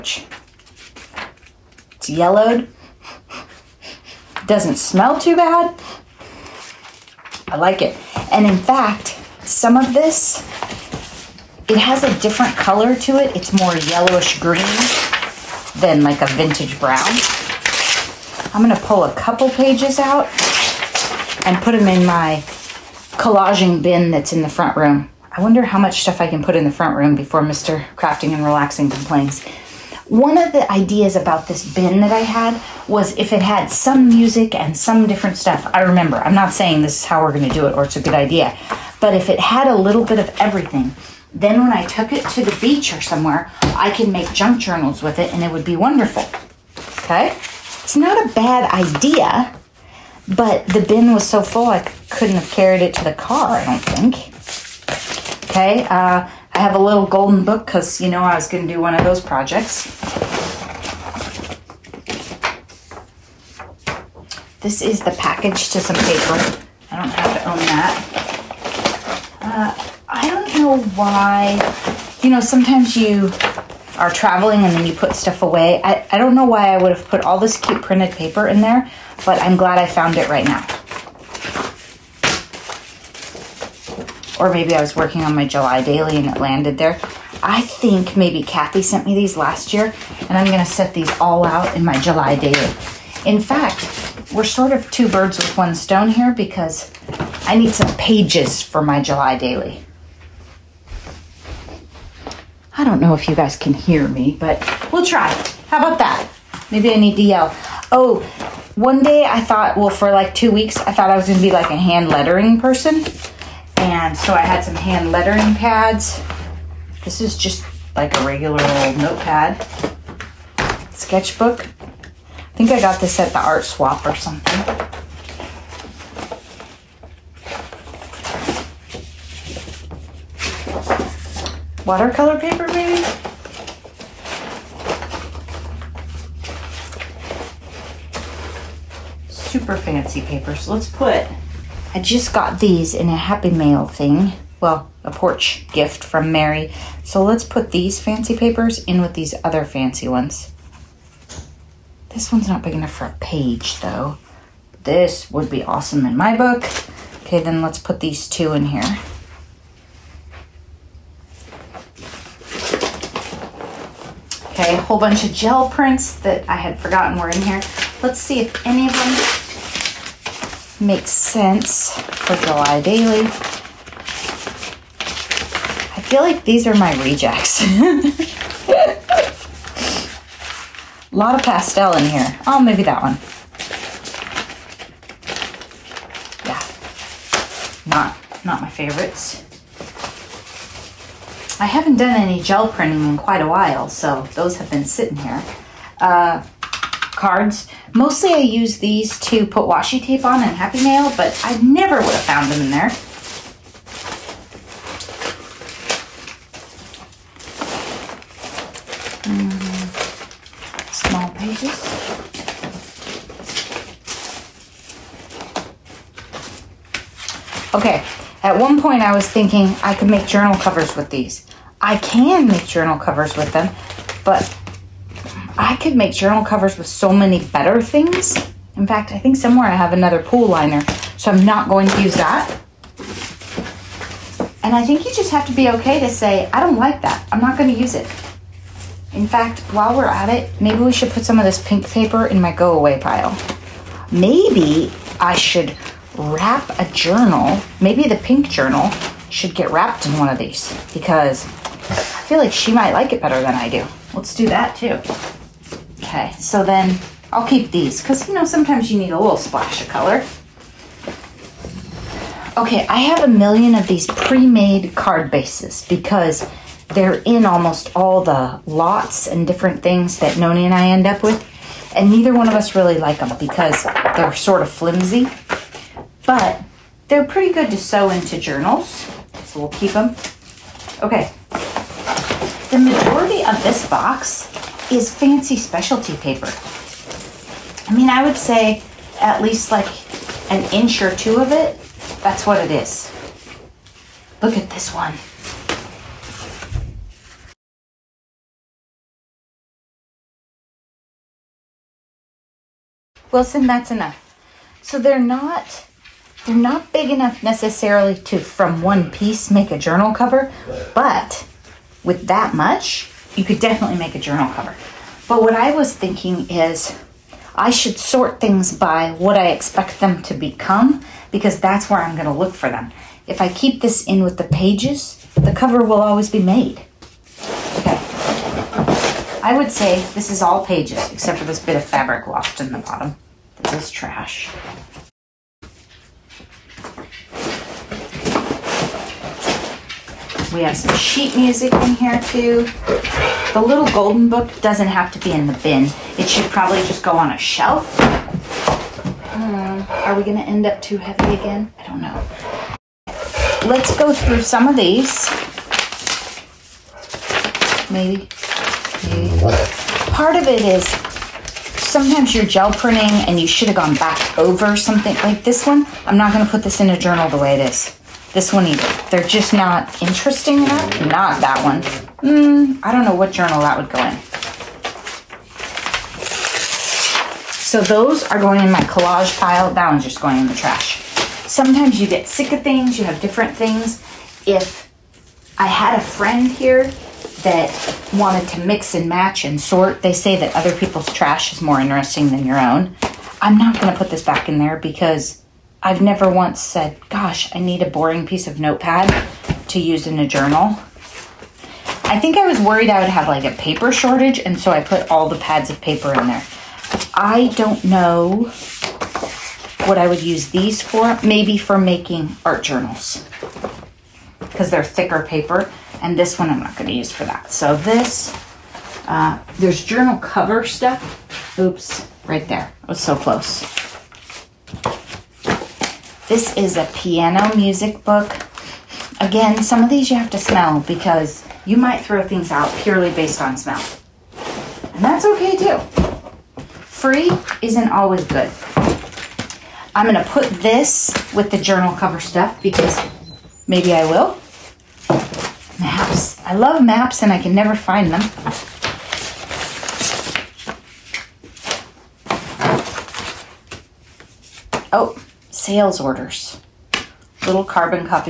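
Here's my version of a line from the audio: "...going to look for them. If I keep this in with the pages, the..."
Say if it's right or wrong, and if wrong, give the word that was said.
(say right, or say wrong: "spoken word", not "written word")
right.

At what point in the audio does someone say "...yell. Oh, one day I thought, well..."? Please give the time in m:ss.
1:47.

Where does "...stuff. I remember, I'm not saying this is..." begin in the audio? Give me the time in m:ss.
0:35.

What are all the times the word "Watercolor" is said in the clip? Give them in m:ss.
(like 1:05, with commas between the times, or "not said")
2:11.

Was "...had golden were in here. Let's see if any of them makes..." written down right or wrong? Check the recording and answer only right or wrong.
wrong.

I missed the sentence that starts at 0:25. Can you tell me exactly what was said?
I wonder how much stuff I can put in the front room before Mr.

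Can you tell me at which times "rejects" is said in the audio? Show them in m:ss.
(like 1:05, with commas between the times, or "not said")
2:57.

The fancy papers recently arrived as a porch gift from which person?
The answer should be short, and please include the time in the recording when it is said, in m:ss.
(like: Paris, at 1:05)
Mary, at 2:26.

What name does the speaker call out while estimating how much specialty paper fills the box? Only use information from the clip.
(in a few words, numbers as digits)
Wilson.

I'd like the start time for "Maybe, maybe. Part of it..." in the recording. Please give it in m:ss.
5:57.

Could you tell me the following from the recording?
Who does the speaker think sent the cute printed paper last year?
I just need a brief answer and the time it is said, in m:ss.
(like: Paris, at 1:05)
Kathy, at 1:28.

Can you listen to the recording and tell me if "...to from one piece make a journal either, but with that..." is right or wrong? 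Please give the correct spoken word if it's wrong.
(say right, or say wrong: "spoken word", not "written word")
wrong: "cover", not "either".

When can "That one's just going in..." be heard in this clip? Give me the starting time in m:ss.
6:19.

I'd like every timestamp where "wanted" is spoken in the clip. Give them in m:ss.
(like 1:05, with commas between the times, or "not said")
6:28.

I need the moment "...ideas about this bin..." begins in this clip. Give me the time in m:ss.
0:30.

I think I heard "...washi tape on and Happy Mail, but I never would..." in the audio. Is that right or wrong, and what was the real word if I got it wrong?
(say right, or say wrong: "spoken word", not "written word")
right.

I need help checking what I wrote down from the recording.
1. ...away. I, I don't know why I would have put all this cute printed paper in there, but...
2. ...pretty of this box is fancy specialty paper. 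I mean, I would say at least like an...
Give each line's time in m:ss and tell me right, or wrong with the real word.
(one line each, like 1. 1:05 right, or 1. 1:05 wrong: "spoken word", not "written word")
1. 1:15 right
2. 4:42 wrong: "majority", not "pretty".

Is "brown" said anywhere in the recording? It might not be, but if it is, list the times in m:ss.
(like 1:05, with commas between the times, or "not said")
0:16.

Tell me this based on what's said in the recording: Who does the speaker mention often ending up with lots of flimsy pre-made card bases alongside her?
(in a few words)
Noni.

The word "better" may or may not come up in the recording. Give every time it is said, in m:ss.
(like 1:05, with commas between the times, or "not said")
3:47, 4:13.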